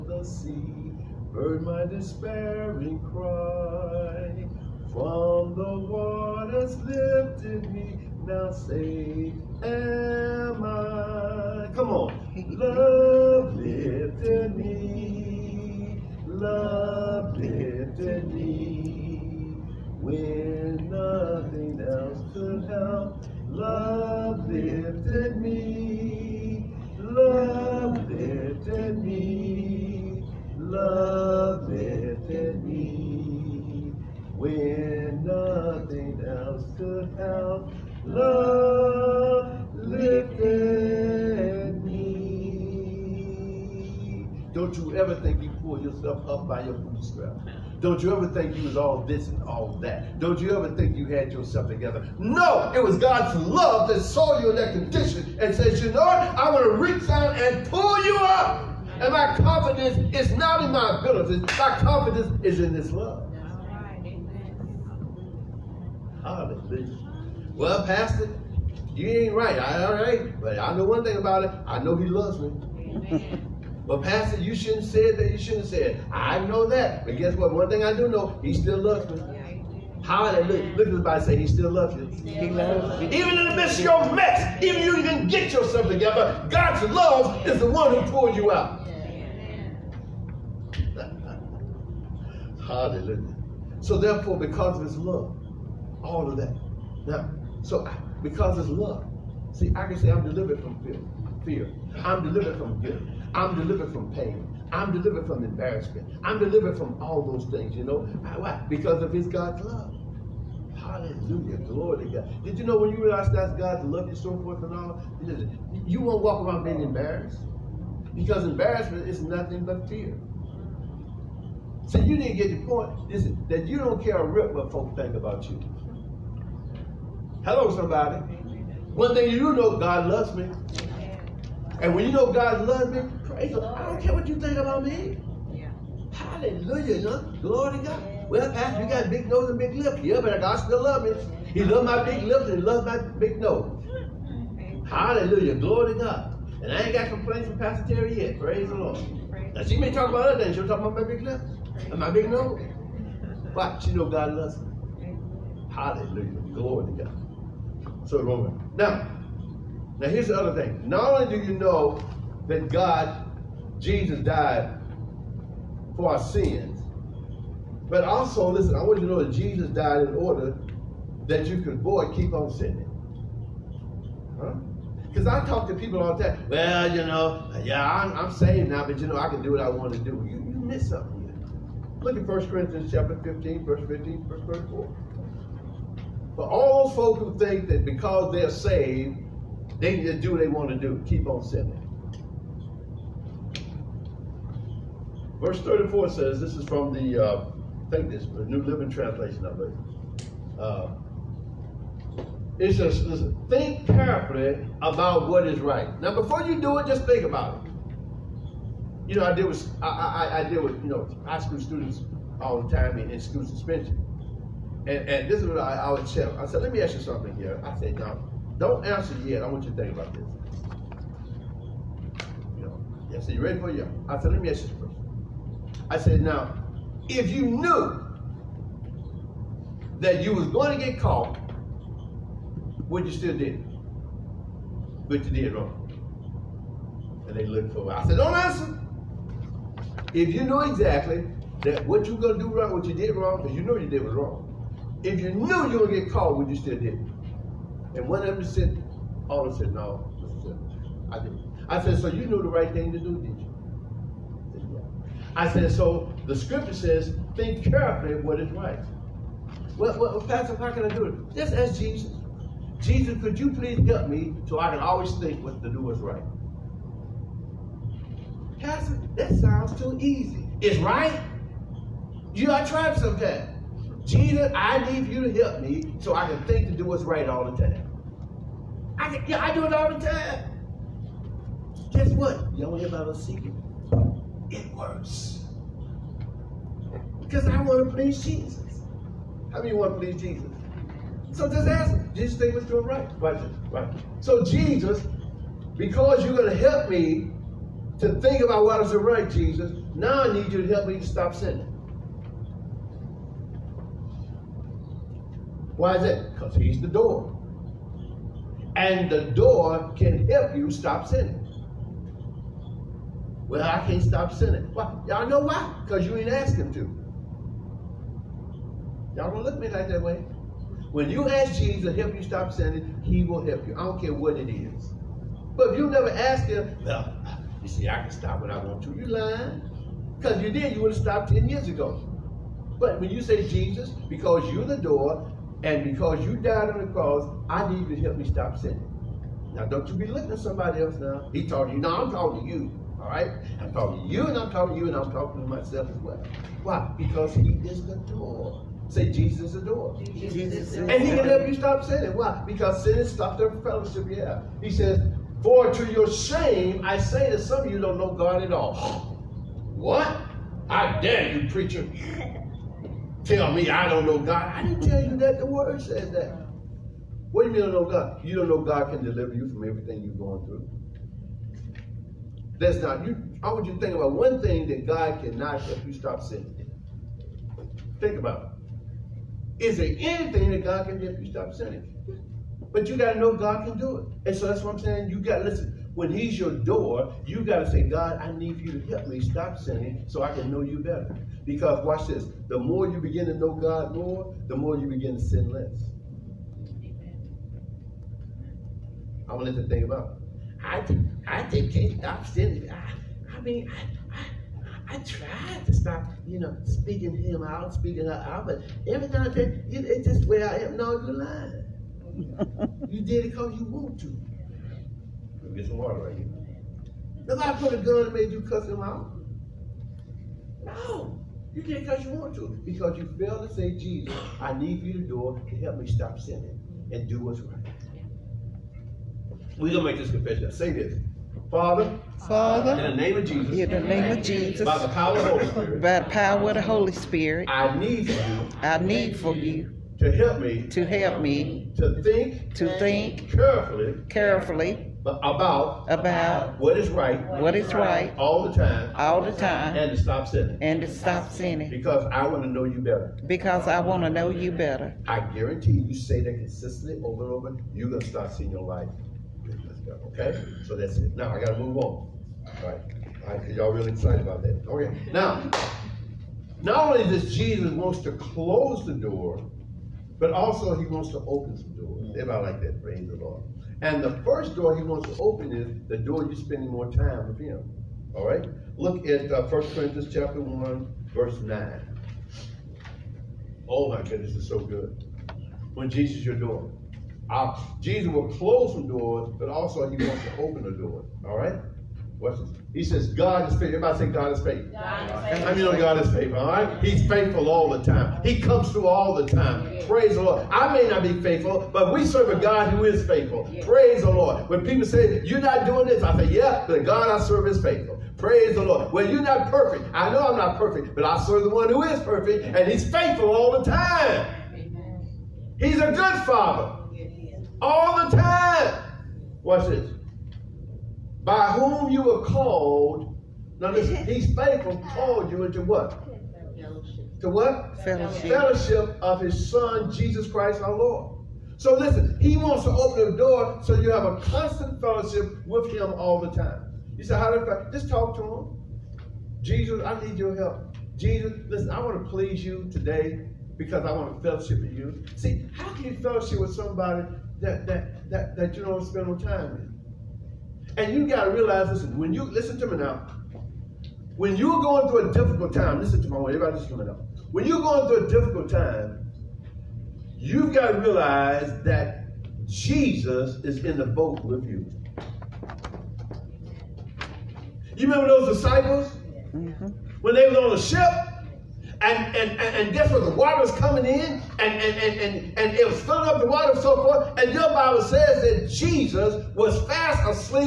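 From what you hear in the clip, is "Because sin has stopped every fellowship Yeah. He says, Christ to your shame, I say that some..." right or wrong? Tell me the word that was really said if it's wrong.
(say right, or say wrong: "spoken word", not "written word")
wrong: "For", not "Christ".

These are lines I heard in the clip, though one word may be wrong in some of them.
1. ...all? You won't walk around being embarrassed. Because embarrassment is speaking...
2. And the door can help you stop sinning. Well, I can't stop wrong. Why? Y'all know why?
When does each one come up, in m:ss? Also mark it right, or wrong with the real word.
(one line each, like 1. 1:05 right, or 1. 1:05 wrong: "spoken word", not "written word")
1. 1:54 wrong: "nothing", not "speaking"
2. 5:08 wrong: "sinning", not "wrong".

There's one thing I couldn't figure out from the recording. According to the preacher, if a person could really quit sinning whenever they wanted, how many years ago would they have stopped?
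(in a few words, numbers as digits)
10 years.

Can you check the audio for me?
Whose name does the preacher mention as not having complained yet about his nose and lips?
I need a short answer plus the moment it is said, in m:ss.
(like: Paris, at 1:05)
Pastor Terry, at 2:27.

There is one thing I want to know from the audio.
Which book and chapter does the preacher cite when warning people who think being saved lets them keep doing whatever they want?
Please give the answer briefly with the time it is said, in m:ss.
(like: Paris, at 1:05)
1 Corinthians 15, at 3:02.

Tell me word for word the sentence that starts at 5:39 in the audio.
Now, don't you be looking at somebody else now.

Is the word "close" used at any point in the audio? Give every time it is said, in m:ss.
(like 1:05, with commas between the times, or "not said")
7:48, 8:08.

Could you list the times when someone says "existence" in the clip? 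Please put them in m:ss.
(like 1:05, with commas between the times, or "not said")
not said.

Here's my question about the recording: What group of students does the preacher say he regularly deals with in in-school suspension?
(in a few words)
High school students.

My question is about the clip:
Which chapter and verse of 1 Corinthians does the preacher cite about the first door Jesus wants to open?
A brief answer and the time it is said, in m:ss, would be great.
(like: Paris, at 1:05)
Chapter 1, verse 9, at 8:00.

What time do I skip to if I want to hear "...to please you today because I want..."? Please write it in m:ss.
9:02.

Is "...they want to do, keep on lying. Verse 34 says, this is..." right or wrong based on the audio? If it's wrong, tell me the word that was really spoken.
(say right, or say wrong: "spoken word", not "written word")
wrong: "sinning", not "lying".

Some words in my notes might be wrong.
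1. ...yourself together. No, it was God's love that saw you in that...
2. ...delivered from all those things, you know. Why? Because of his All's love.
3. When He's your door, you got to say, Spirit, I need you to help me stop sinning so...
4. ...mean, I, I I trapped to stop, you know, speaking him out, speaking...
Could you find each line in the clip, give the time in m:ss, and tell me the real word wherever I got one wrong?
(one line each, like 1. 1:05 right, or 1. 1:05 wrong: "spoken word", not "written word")
1. 0:51 right
2. 1:46 wrong: "God", not "All"
3. 6:25 wrong: "God", not "Spirit"
4. 6:43 wrong: "tried", not "trapped".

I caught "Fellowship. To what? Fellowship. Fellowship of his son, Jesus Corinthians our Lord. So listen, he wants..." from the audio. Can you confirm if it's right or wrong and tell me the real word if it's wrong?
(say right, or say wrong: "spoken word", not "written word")
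wrong: "Christ", not "Corinthians".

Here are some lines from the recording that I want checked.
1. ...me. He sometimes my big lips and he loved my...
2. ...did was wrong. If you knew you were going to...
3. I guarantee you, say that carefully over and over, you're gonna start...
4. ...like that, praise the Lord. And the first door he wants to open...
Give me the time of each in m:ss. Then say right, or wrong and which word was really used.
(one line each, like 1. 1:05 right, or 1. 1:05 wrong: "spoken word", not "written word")
1. 2:21 wrong: "loves", not "sometimes"
2. 4:03 right
3. 7:35 wrong: "consistently", not "carefully"
4. 7:52 right.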